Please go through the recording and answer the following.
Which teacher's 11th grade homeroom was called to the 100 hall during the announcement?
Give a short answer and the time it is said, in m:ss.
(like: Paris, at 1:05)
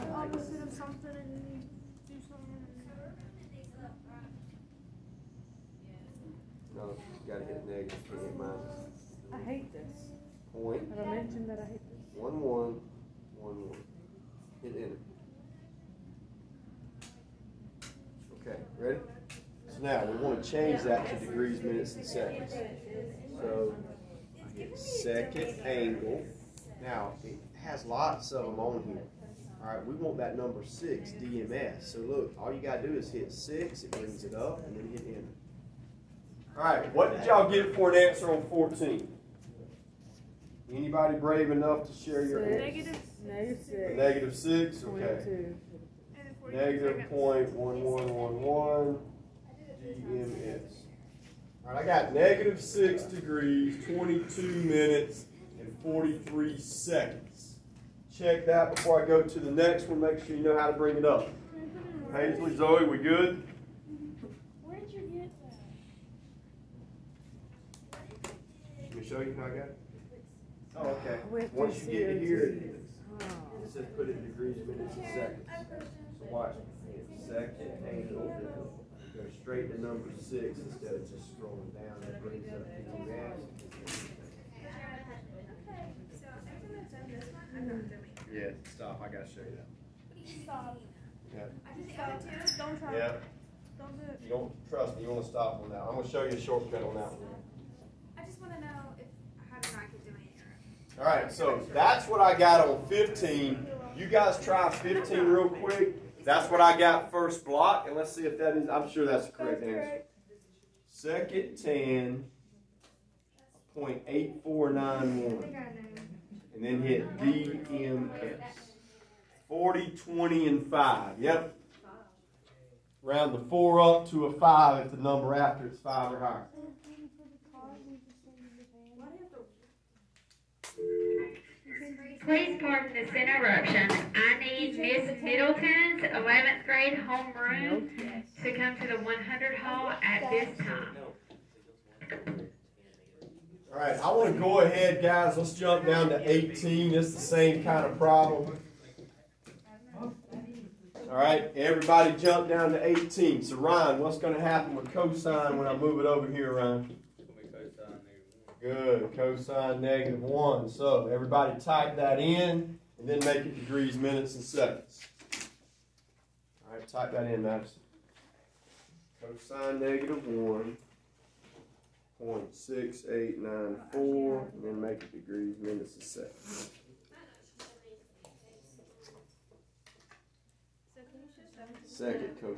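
Miss Middleton, at 2:14.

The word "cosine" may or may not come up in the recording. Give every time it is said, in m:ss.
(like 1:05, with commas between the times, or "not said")
2:34, 2:39, 2:49.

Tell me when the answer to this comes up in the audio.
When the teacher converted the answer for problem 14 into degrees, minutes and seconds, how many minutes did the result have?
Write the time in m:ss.
0:53.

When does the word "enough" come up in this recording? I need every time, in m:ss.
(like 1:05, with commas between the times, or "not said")
0:41.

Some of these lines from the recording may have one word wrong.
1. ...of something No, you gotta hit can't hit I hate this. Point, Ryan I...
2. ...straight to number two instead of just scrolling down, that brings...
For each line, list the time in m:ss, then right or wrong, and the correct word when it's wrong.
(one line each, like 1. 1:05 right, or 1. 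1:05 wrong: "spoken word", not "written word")
1. 0:00 wrong: "Have", not "Ryan"
2. 1:19 wrong: "six", not "two".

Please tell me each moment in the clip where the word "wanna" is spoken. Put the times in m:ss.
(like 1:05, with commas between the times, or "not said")
0:20, 1:35.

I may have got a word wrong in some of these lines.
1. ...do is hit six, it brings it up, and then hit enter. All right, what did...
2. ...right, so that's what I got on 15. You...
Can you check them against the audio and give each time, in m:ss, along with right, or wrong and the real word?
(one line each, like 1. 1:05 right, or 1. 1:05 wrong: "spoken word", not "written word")
1. 0:32 right
2. 1:41 right.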